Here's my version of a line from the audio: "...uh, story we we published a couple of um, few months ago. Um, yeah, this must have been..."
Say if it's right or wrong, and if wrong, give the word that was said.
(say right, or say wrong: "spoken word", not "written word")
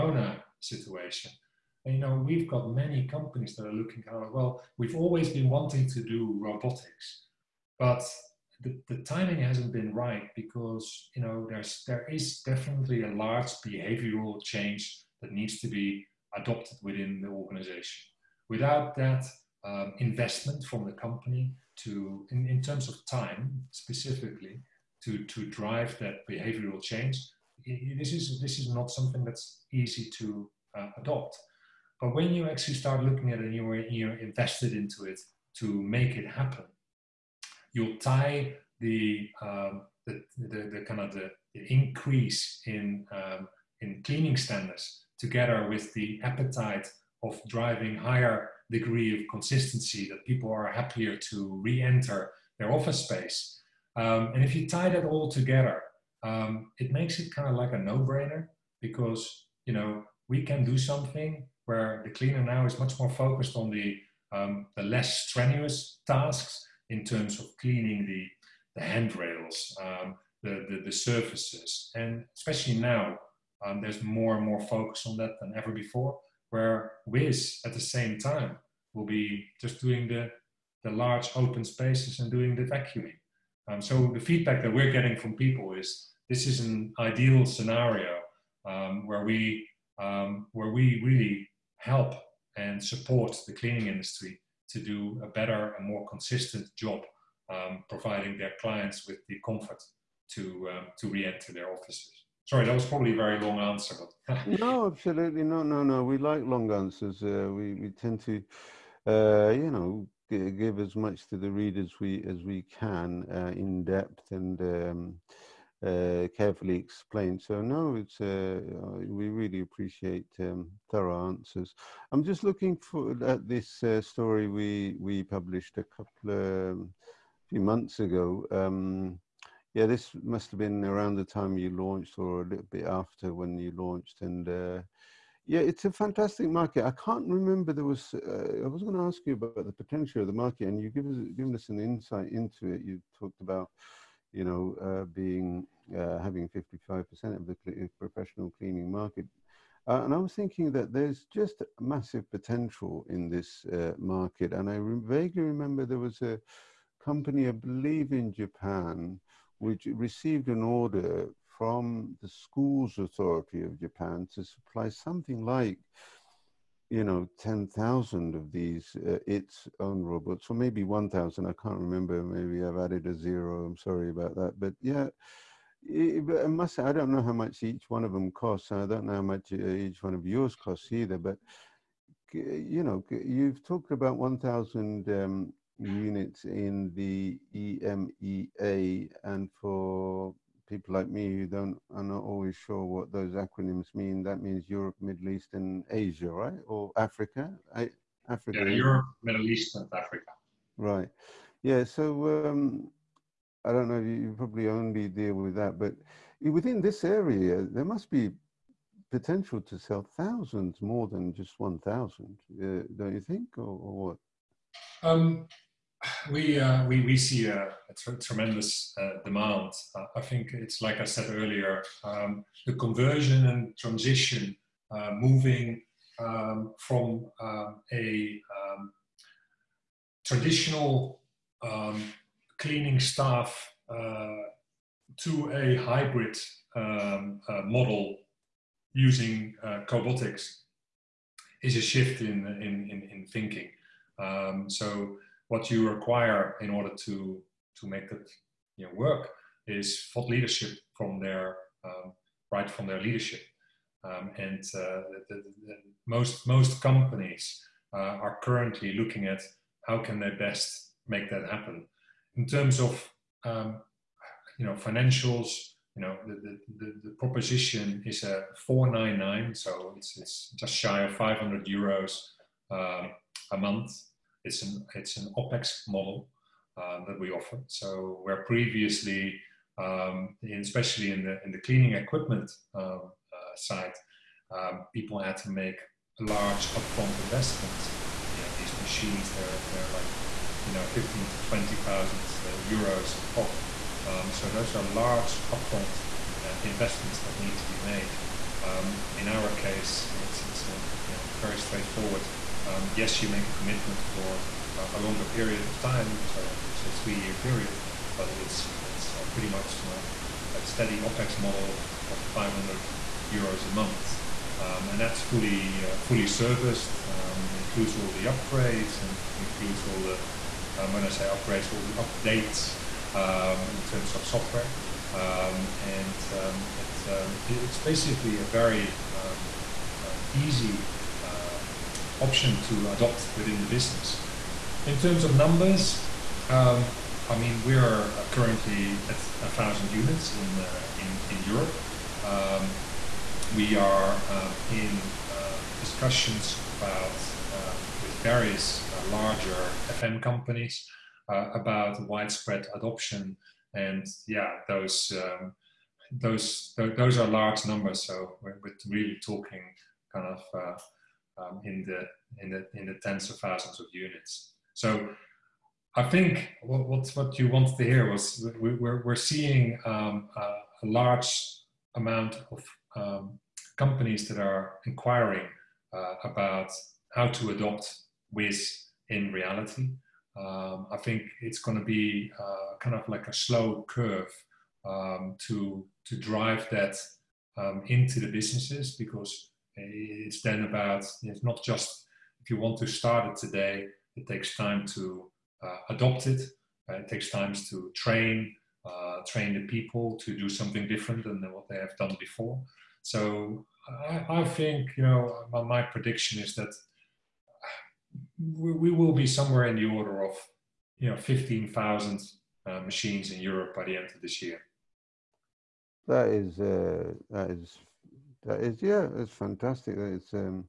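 right.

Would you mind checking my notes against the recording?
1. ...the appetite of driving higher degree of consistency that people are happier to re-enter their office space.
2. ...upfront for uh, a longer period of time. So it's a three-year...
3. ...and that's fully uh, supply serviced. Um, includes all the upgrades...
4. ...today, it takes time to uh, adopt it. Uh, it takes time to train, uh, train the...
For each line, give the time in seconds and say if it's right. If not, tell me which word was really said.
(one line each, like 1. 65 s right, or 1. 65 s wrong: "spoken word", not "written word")
1. 45 s right
2. 303 s wrong: "commitment", not "upfront"
3. 314 s wrong: "fully", not "supply"
4. 393 s right.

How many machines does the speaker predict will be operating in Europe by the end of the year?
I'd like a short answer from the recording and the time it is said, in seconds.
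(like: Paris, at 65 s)
15,000, at 411 s.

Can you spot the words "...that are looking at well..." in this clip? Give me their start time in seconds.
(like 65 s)
3 s.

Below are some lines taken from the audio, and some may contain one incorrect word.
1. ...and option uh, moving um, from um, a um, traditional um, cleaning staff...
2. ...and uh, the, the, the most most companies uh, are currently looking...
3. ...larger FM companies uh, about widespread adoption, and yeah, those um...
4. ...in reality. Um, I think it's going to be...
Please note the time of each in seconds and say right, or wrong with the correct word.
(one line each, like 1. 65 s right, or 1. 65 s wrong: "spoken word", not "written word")
1. 223 s wrong: "transition", not "option"
2. 254 s right
3. 349 s right
4. 379 s right.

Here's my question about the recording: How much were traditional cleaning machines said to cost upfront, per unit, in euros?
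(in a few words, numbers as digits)
15,000 to 20,000 euros.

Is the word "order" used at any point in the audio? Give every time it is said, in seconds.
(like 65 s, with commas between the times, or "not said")
160 s, 246 s, 409 s.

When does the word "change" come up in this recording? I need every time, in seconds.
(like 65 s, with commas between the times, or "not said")
14 s, 26 s.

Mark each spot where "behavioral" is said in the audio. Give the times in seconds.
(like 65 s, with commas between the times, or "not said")
13 s, 26 s.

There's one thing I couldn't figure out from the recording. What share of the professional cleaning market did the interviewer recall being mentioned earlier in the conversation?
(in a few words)
55%.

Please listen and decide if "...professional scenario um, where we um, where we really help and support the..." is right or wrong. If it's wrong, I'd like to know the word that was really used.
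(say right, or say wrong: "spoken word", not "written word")
wrong: "ideal", not "professional".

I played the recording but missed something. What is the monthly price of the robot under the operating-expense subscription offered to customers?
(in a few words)
499 euros.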